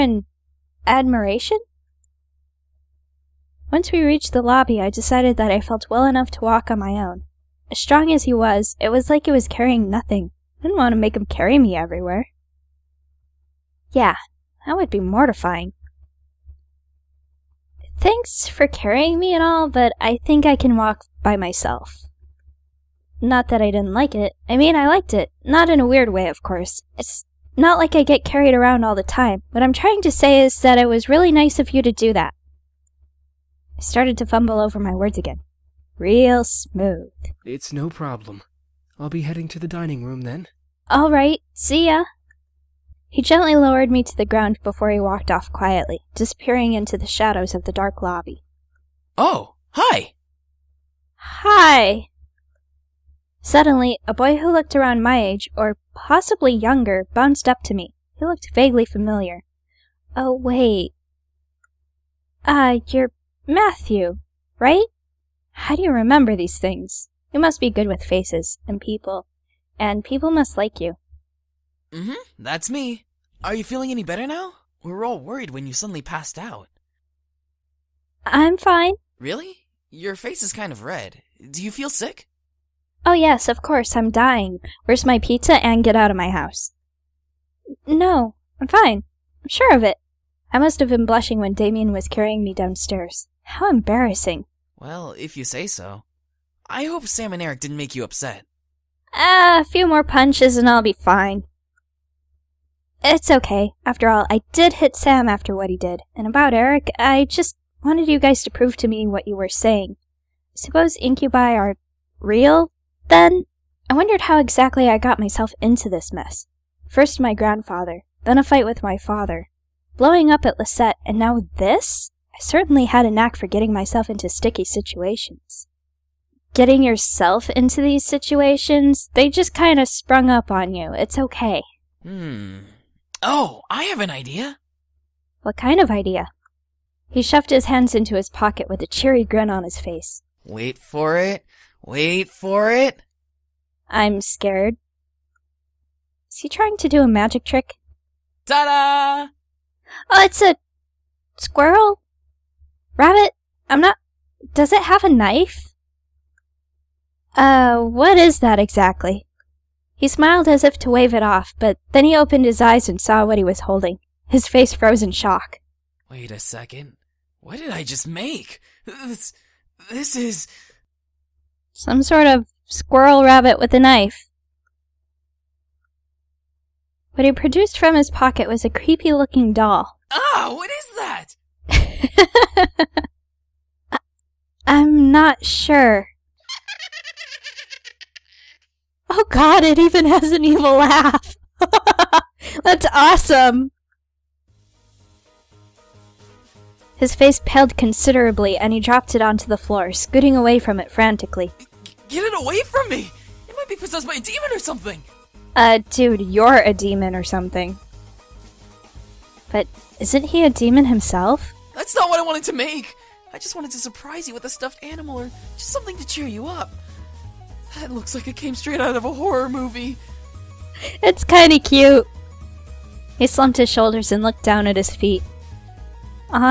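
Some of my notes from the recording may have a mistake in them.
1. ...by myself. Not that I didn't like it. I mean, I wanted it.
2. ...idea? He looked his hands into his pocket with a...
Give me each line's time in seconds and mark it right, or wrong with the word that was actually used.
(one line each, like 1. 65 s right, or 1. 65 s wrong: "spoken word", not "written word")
1. 21 s wrong: "liked", not "wanted"
2. 135 s wrong: "shoved", not "looked".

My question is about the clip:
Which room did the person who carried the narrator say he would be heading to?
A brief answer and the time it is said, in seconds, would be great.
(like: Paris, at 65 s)
The dining room, at 39 s.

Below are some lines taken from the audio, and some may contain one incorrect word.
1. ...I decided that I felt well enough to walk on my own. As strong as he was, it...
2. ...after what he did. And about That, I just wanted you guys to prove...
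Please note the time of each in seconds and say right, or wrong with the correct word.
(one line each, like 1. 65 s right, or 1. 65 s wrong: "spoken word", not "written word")
1. 4 s right
2. 105 s wrong: "Eric", not "That".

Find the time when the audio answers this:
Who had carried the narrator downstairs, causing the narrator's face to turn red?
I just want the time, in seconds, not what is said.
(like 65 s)
91 s.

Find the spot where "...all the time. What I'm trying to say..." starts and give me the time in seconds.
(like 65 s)
28 s.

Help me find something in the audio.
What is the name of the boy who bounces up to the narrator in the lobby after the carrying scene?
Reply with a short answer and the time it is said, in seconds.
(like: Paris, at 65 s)
Matthew, at 63 s.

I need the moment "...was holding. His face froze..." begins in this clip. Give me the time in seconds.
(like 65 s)
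163 s.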